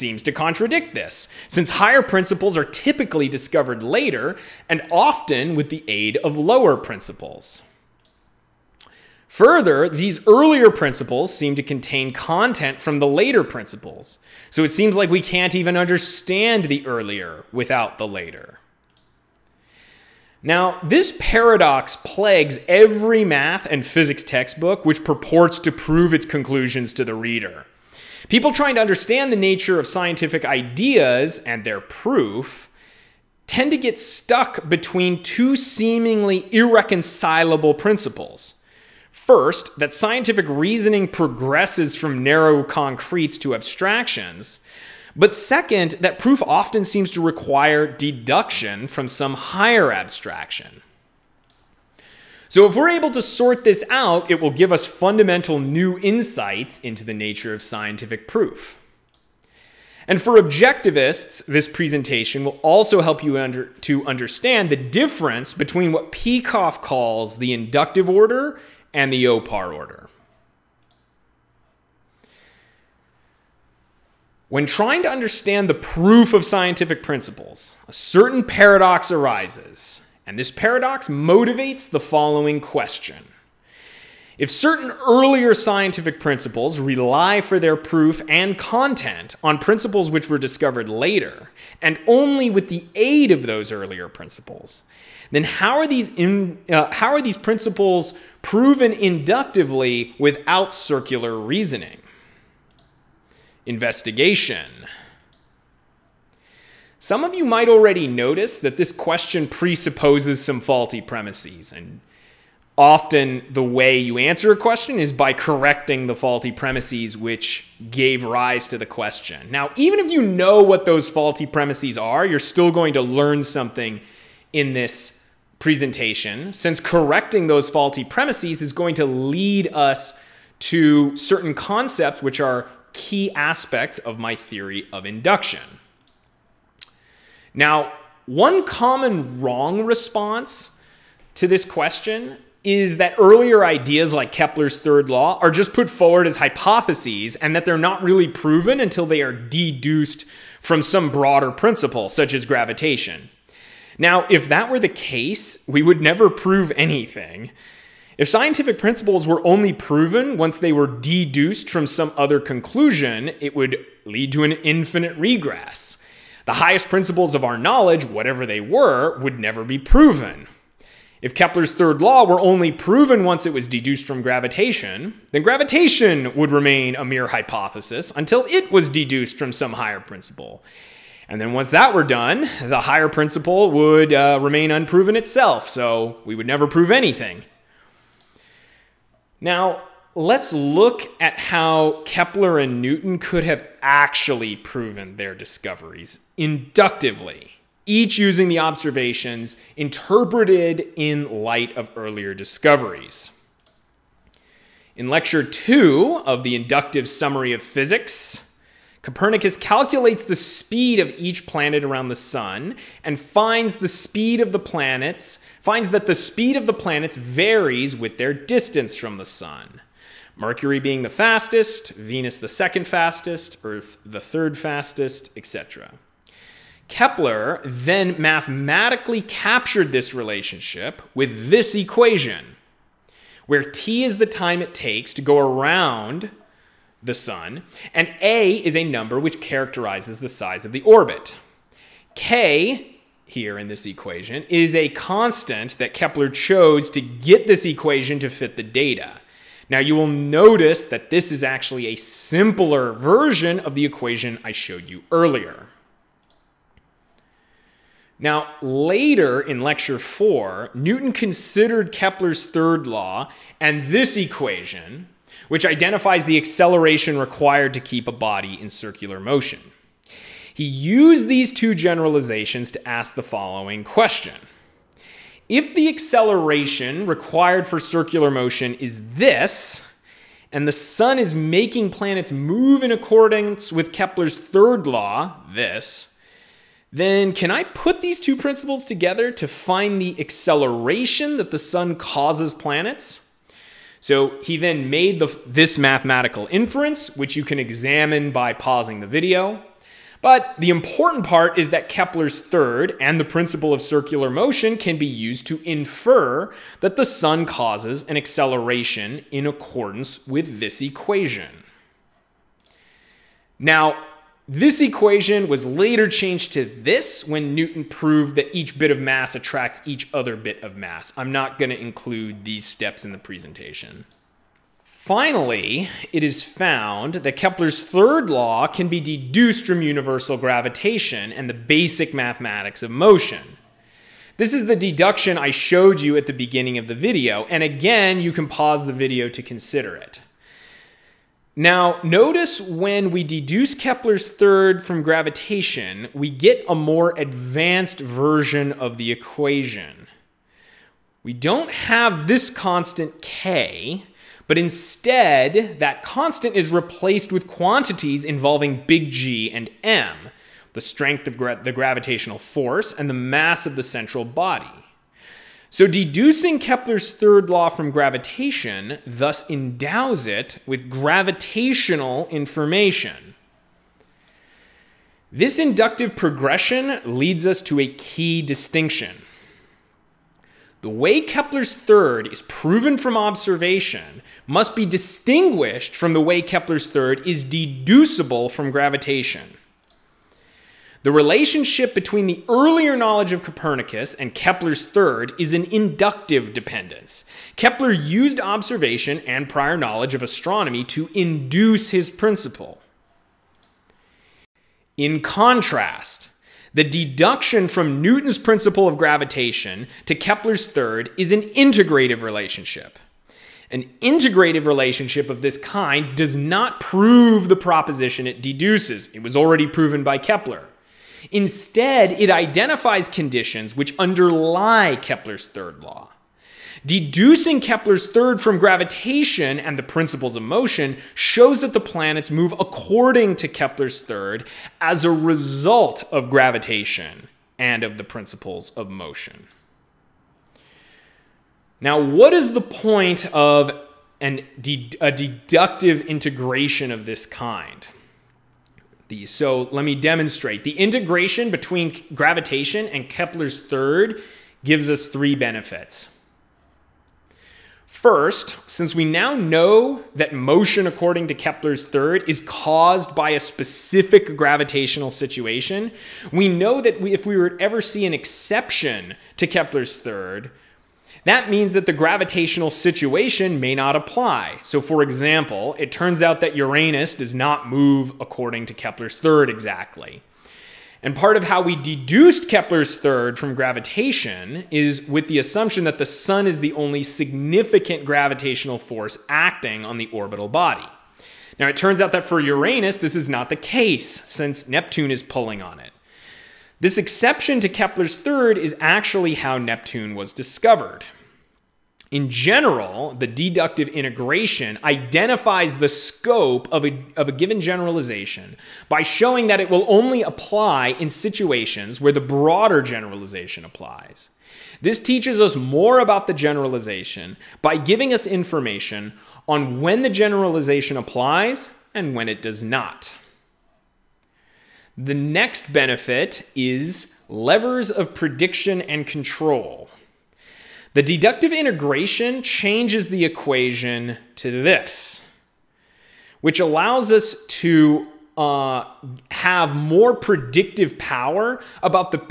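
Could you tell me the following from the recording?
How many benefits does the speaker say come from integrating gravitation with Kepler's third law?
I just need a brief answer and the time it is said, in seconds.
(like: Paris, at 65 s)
3, at 455 s.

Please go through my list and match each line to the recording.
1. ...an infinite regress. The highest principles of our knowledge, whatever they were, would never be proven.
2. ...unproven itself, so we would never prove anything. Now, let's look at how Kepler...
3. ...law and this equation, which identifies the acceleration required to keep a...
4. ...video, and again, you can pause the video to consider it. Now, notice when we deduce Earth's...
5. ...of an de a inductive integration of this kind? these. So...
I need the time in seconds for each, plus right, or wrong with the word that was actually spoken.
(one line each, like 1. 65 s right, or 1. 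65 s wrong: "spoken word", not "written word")
1. 164 s right
2. 184 s right
3. 262 s right
4. 336 s wrong: "Kepler", not "Earth"
5. 443 s wrong: "deductive", not "inductive".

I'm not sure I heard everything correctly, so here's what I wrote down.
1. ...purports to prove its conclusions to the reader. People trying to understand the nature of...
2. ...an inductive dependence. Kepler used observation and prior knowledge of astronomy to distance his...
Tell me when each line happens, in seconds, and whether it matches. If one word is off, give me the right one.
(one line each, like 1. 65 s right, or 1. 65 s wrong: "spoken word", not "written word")
1. 25 s right
2. 395 s wrong: "induce", not "distance".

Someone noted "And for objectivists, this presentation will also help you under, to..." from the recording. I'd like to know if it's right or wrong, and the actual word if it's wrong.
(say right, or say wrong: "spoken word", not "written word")
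right.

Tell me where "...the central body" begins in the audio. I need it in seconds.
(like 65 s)
363 s.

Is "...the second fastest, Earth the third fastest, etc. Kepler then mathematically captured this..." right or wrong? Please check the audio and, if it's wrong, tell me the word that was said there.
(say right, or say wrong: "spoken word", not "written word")
right.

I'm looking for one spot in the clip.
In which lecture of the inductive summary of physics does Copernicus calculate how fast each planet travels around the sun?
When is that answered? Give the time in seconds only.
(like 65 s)
205 s.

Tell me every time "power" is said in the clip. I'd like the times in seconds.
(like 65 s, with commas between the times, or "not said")
540 s.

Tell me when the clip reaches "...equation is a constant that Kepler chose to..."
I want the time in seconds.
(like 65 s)
243 s.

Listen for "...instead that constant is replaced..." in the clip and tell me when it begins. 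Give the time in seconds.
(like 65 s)
354 s.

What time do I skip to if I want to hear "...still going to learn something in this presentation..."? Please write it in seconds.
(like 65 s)
122 s.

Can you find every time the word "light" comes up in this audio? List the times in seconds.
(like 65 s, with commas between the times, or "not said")
201 s.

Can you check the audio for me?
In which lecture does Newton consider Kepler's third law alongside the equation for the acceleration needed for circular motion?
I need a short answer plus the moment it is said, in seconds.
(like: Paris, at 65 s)
Lecture four, at 259 s.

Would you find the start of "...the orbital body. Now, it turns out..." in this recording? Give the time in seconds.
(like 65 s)
489 s.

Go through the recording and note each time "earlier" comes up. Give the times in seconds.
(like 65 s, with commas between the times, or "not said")
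10 s, 16 s, 85 s, 93 s, 143 s, 201 s, 255 s, 392 s.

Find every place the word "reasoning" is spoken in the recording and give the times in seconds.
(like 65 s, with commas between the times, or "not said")
40 s, 101 s.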